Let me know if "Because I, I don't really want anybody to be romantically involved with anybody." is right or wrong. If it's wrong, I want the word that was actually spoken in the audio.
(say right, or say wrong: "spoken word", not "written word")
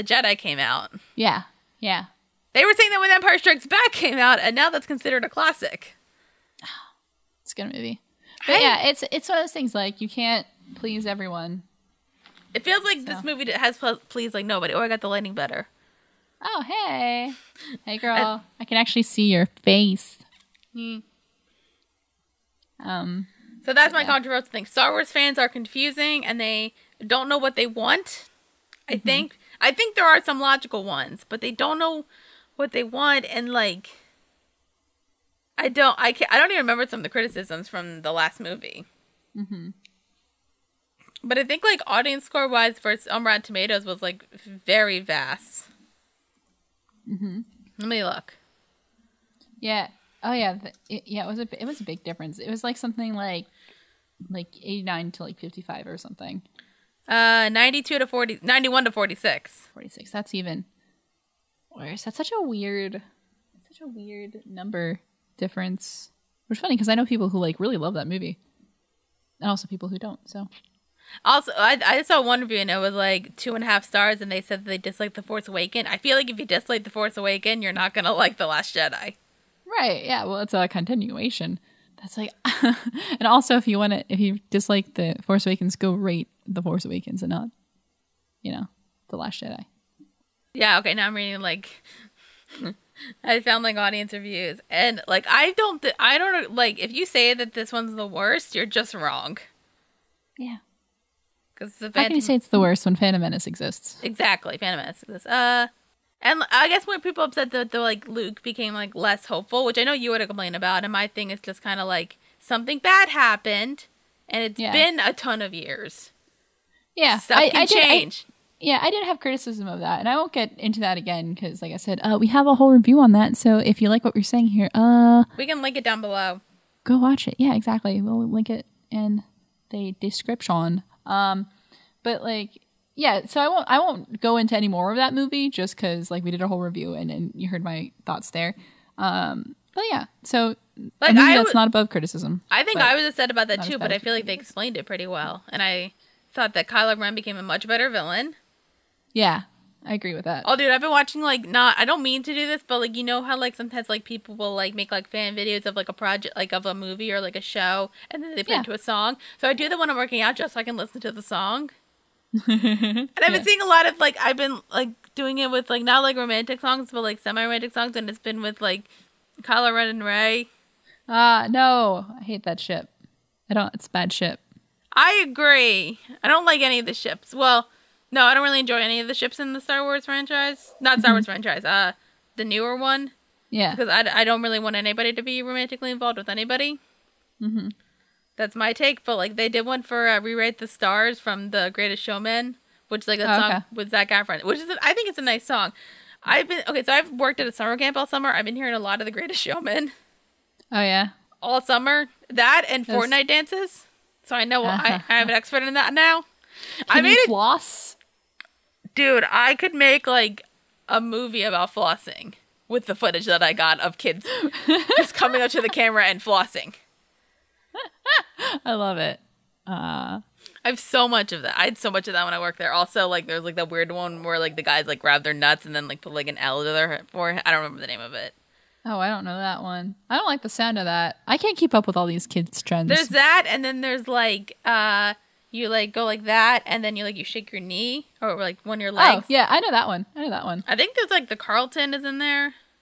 right.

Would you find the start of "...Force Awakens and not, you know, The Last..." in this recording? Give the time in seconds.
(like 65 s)
86 s.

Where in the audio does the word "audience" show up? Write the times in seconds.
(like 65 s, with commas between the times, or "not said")
41 s, 93 s.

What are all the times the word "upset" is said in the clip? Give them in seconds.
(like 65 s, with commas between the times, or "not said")
107 s, 143 s.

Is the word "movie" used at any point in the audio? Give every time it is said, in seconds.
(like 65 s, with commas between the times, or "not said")
7 s, 13 s, 38 s, 68 s, 135 s, 156 s, 210 s.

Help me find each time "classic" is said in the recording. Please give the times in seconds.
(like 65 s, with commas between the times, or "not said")
5 s.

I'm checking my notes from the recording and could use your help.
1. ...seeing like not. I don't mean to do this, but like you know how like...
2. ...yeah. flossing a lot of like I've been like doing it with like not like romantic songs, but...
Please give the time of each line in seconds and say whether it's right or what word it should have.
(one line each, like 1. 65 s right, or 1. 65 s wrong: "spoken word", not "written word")
1. 150 s wrong: "watching", not "seeing"
2. 163 s wrong: "seeing", not "flossing".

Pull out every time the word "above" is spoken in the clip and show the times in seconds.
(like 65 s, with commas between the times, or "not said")
141 s.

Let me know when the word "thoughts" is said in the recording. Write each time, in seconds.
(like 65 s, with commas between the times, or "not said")
138 s, 146 s.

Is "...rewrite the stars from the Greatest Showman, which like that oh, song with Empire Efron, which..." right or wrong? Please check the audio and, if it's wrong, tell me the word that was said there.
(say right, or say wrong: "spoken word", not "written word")
wrong: "Zac", not "Empire".